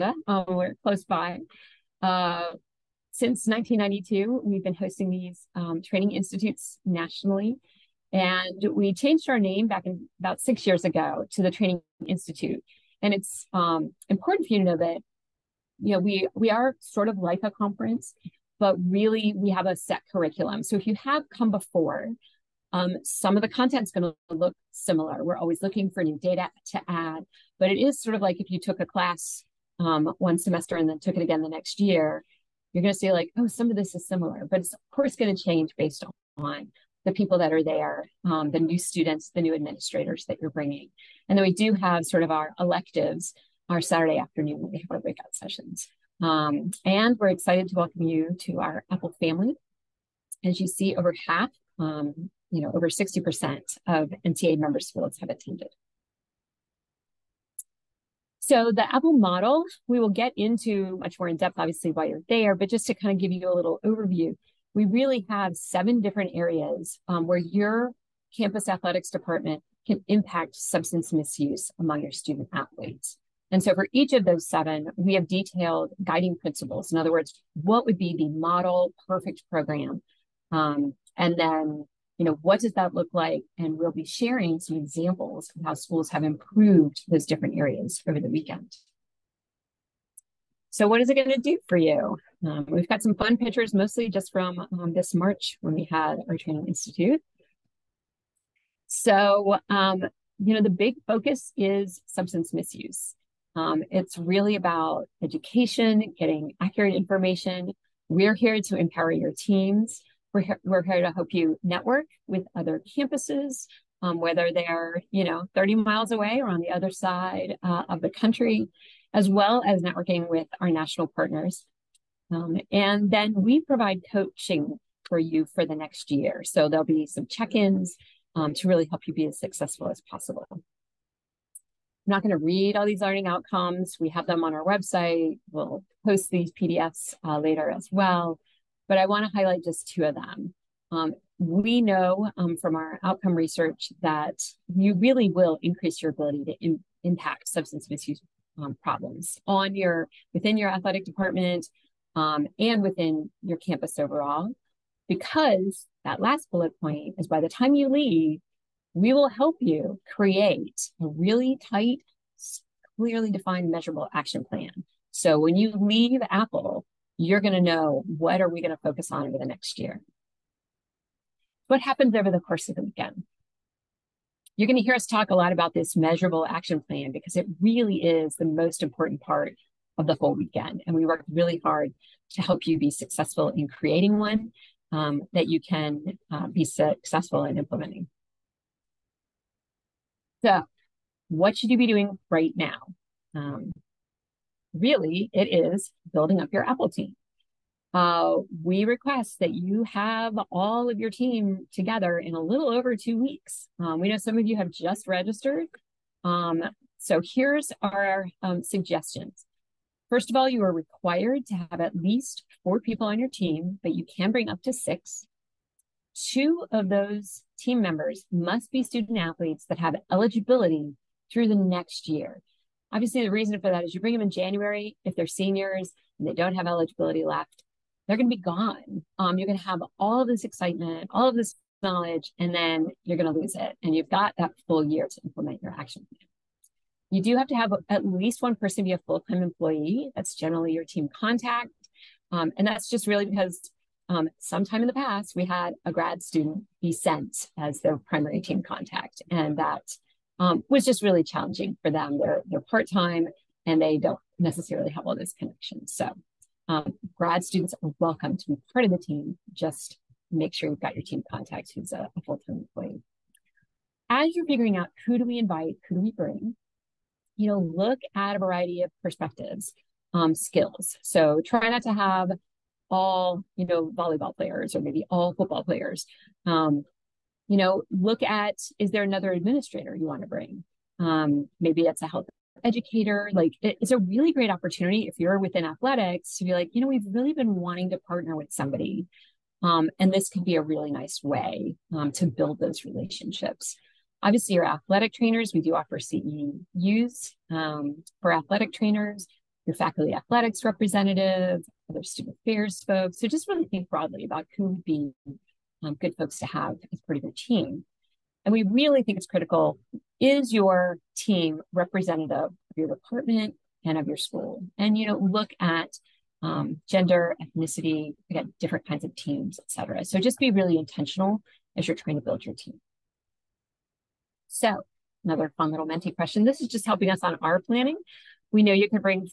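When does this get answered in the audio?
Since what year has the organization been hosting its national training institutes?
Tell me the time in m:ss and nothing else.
0:03.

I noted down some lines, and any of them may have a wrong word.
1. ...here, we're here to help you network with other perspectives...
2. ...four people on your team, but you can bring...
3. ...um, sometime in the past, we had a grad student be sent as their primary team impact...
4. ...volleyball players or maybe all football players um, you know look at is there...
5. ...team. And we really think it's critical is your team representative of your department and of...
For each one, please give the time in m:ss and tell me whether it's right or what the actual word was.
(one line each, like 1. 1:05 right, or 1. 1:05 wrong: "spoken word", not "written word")
1. 1:50 wrong: "campuses", not "perspectives"
2. 3:32 right
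3. 4:04 wrong: "contact", not "impact"
4. 4:33 right
5. 5:07 right.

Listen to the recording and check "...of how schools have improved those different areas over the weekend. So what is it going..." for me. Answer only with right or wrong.
right.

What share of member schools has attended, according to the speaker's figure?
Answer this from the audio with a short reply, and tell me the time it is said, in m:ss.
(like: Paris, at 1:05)
over 60%, at 0:52.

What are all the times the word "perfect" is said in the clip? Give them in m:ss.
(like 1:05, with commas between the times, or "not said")
1:19.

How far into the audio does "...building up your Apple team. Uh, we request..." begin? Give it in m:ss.
3:16.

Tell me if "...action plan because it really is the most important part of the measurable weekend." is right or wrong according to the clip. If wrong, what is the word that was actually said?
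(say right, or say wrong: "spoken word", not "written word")
wrong: "whole", not "measurable".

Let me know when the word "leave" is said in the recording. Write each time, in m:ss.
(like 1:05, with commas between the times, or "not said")
2:37, 2:45.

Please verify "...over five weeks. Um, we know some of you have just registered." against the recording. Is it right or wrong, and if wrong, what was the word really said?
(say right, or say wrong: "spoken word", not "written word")
wrong: "two", not "five".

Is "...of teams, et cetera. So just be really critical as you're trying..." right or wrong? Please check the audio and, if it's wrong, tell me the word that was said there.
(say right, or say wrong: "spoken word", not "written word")
wrong: "intentional", not "critical".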